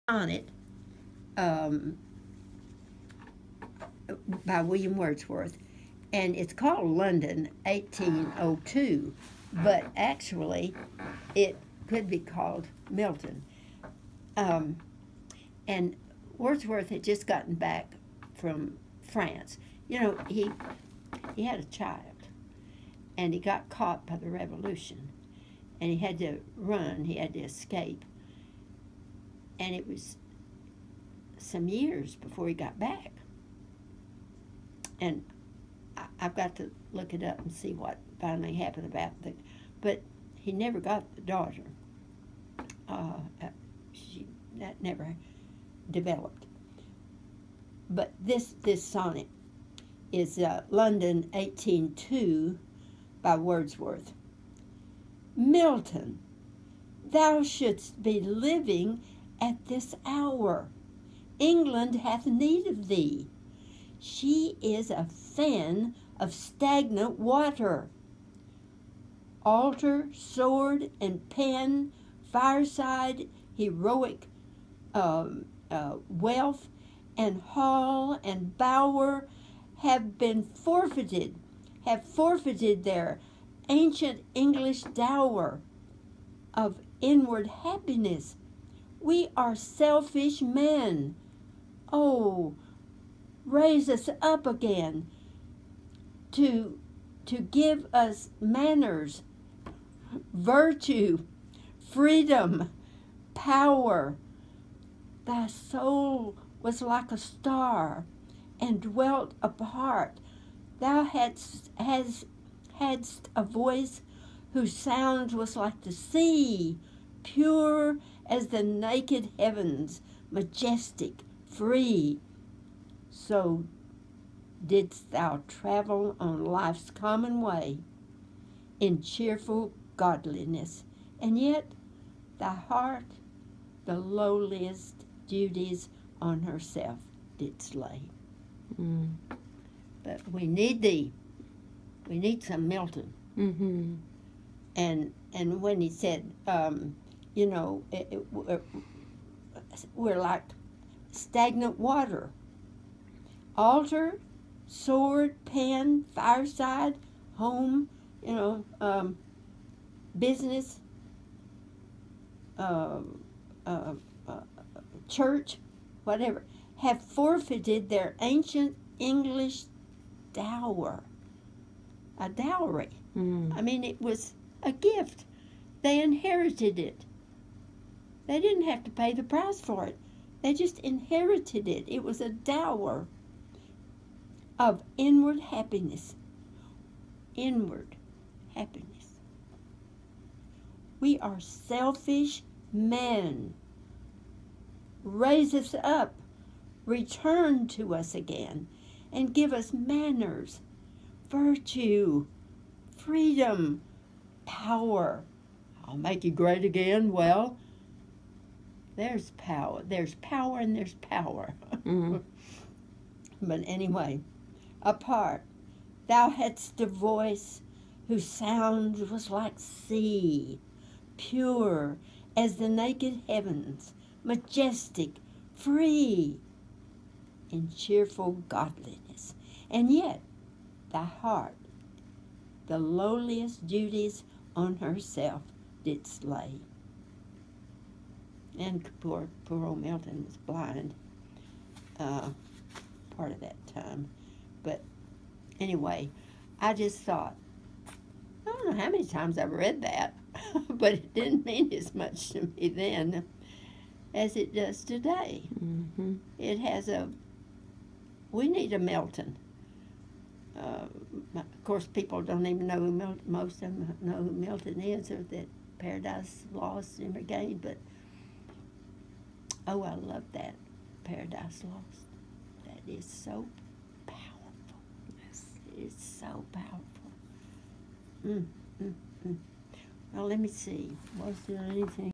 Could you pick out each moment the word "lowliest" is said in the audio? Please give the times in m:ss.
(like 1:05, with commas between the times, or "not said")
2:13, 3:52.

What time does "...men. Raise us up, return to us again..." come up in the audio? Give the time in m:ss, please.
3:12.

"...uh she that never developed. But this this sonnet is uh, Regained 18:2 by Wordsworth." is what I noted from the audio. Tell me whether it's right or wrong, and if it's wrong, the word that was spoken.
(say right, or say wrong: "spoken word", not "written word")
wrong: "London", not "Regained".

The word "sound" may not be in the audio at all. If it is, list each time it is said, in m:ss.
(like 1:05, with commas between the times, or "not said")
1:54, 3:38.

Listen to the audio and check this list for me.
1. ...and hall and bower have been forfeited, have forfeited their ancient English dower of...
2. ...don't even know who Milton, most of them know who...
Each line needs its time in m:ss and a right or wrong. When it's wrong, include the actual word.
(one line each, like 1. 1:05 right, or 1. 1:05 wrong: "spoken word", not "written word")
1. 1:17 right
2. 4:22 right.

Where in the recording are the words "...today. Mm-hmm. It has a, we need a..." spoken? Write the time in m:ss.
4:14.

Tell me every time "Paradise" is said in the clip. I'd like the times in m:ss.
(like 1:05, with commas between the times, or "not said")
4:25, 4:31.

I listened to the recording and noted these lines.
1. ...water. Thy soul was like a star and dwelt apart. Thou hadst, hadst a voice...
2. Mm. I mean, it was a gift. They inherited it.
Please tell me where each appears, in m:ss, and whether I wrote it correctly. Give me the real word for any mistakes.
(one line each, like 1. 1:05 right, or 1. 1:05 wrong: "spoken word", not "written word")
1. 1:43 wrong: "power", not "water"
2. 2:53 right.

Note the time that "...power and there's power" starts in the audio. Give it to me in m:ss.
3:30.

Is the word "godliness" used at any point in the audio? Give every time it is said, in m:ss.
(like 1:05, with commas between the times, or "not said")
2:09, 3:48.